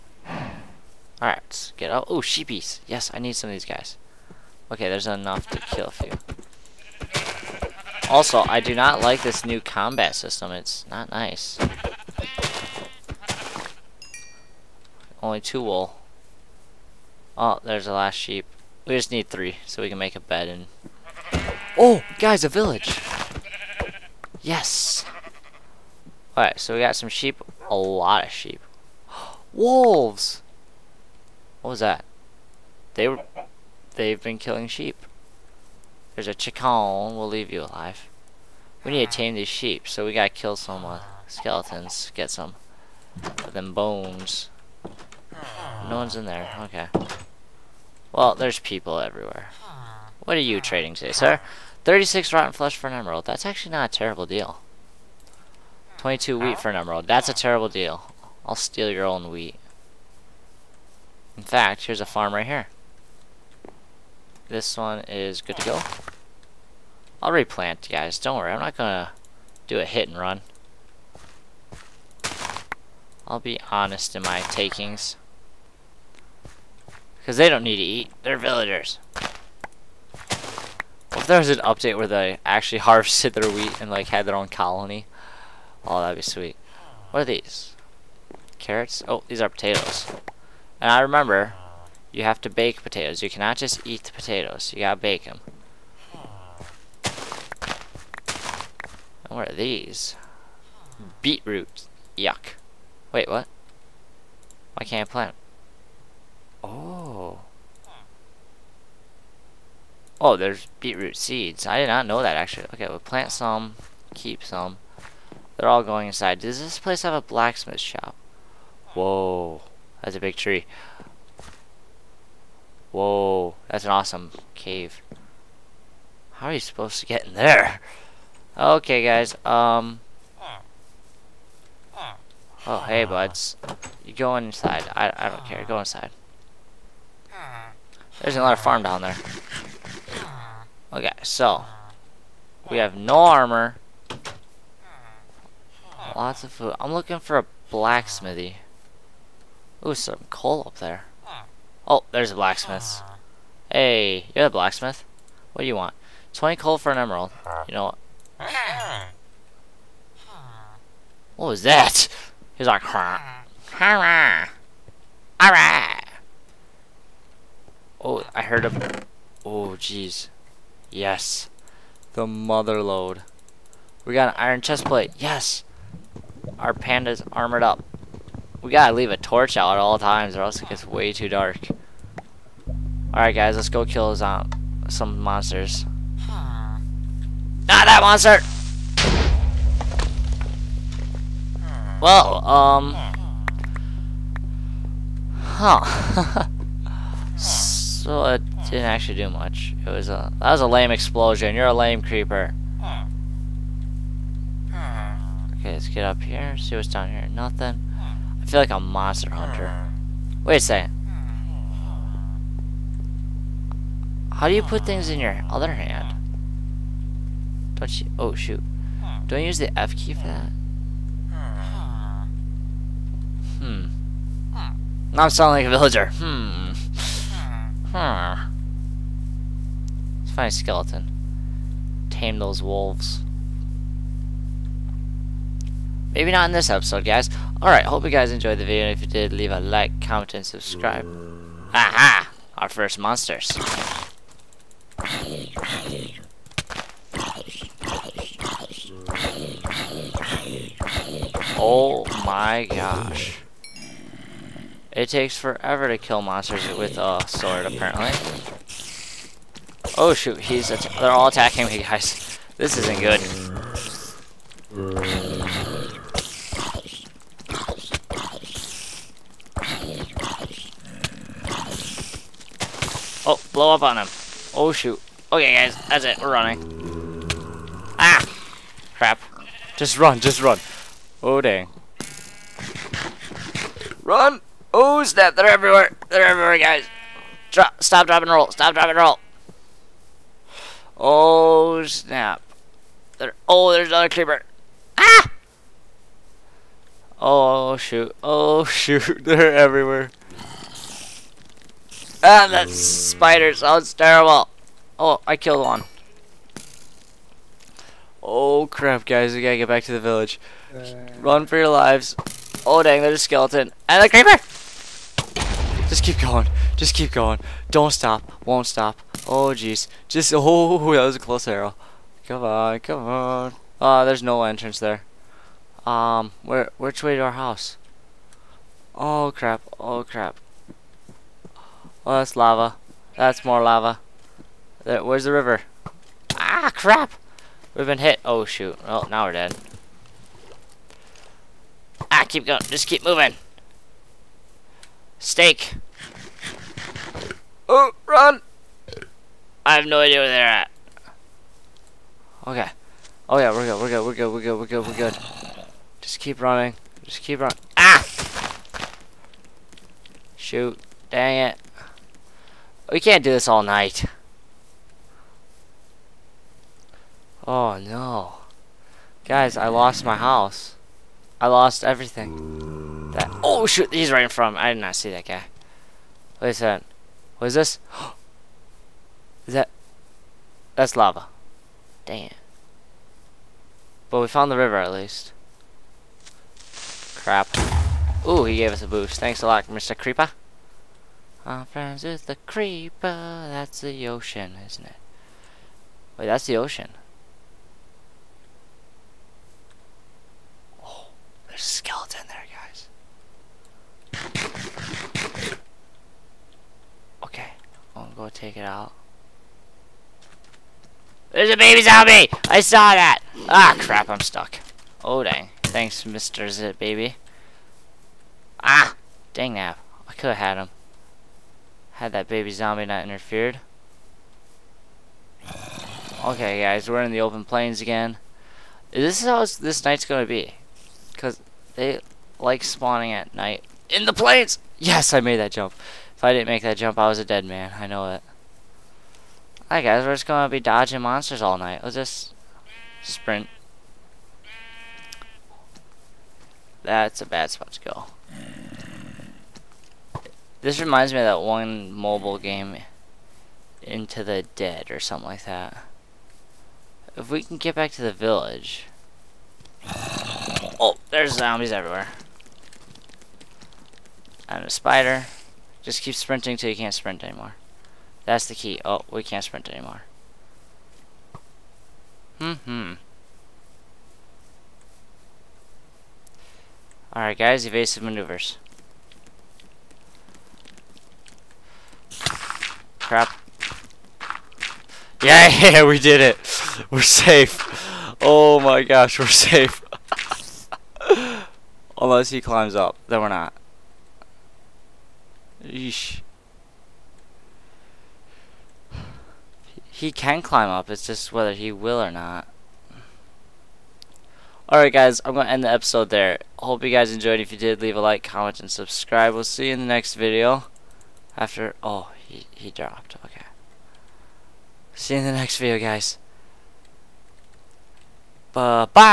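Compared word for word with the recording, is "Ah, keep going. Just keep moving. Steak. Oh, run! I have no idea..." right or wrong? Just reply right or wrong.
right.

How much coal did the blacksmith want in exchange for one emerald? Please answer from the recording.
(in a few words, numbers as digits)
20.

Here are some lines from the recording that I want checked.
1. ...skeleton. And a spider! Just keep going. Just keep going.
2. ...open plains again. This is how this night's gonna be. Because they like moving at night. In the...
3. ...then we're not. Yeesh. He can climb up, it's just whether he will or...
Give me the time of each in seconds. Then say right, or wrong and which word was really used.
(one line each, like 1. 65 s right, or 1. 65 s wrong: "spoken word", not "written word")
1. 313 s wrong: "creeper", not "spider"
2. 427 s wrong: "spawning", not "moving"
3. 493 s right.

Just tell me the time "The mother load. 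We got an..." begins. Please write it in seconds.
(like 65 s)
172 s.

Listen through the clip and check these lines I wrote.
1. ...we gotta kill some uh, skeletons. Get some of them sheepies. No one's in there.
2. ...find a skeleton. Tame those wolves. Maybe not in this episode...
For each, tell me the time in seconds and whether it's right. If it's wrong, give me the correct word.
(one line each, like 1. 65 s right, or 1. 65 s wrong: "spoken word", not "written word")
1. 40 s wrong: "bones", not "sheepies"
2. 230 s right.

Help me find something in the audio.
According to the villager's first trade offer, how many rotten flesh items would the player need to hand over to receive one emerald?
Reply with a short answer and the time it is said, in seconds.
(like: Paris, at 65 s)
36, at 51 s.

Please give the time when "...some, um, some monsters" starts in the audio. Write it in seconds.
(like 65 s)
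184 s.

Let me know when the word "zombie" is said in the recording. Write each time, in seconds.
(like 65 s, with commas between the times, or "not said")
411 s, 422 s, 461 s.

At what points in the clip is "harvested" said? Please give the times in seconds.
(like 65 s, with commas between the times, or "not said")
82 s.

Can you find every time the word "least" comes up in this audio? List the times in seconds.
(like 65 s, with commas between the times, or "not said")
384 s.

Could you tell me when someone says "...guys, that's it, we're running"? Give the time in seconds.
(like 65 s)
275 s.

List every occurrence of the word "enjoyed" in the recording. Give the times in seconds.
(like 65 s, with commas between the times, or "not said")
238 s, 507 s.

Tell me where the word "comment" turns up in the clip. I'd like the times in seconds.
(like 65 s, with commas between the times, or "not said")
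239 s, 508 s.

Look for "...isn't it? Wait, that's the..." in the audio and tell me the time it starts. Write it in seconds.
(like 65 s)
394 s.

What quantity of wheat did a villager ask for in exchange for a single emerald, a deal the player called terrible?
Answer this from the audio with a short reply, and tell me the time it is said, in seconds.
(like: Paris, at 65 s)
22, at 55 s.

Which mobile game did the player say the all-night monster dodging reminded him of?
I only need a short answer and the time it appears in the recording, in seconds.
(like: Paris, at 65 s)
Into the Dead, at 453 s.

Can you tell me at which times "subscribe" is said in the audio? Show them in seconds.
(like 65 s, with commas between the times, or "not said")
240 s, 508 s.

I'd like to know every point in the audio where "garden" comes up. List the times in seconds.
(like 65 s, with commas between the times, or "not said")
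not said.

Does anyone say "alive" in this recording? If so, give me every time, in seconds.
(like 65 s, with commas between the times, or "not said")
37 s.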